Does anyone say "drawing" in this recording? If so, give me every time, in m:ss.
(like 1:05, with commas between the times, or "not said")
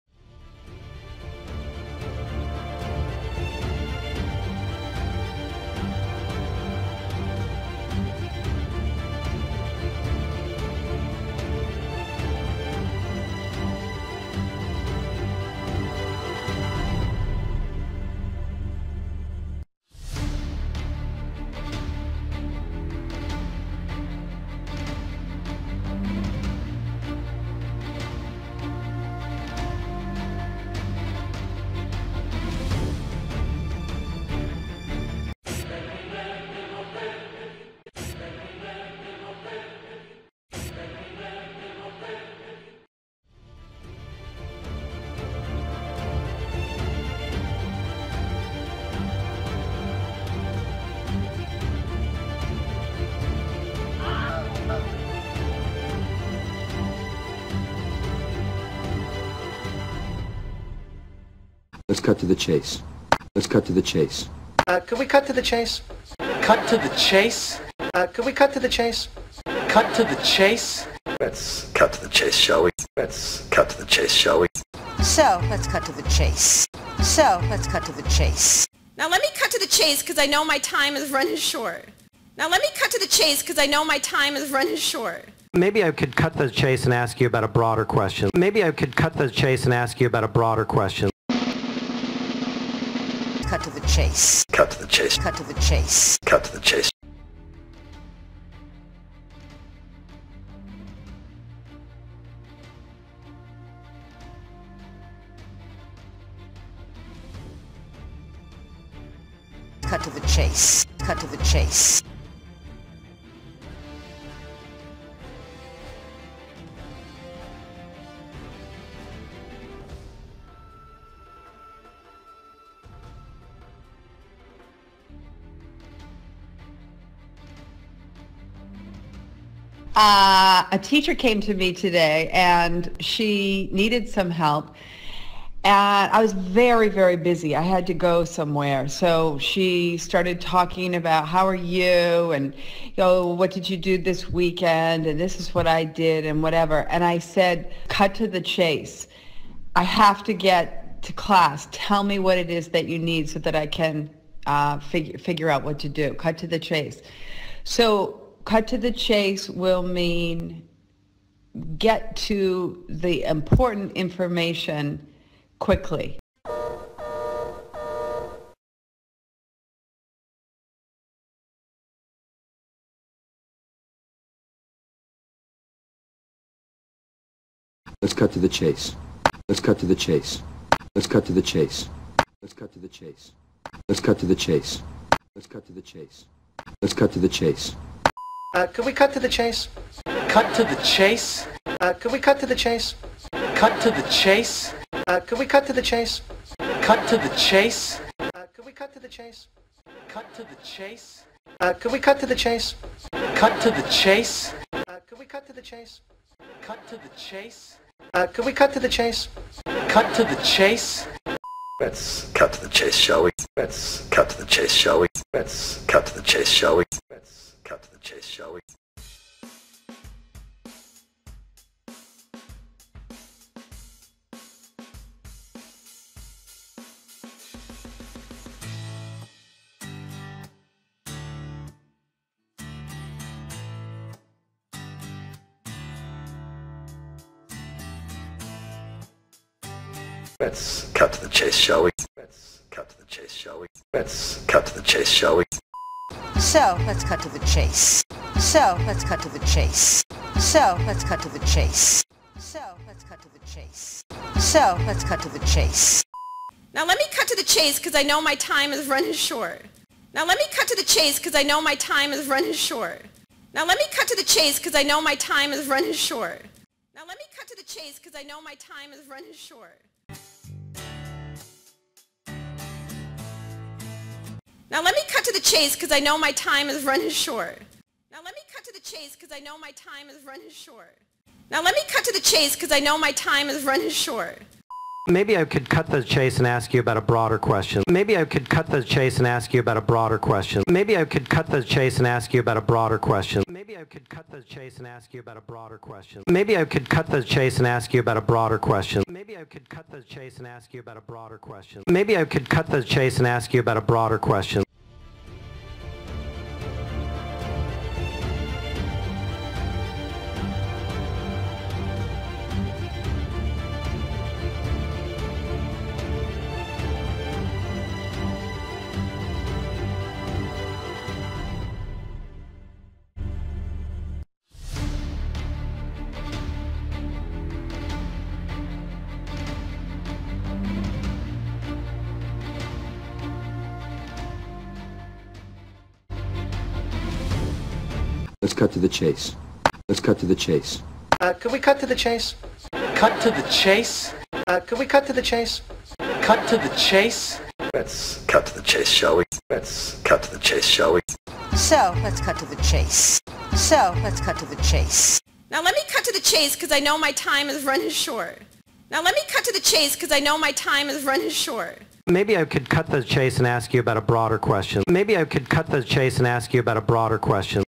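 not said.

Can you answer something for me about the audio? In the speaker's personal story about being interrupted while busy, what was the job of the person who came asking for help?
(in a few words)
teacher.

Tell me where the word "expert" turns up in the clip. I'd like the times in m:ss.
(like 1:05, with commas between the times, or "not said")
not said.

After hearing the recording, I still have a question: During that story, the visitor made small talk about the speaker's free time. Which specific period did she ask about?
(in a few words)
this weekend.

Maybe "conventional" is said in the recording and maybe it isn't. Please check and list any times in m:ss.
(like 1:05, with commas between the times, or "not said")
not said.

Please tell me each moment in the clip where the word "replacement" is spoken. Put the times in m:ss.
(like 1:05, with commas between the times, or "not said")
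not said.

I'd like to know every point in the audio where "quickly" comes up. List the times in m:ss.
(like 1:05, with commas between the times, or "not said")
2:45.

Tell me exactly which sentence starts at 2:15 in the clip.
And I was very, very busy.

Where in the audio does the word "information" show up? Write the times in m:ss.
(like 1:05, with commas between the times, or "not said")
2:43.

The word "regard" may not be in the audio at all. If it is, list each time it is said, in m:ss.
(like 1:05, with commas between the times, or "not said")
not said.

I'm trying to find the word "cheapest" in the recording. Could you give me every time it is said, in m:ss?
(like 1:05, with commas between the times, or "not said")
not said.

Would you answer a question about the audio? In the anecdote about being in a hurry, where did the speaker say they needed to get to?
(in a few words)
class.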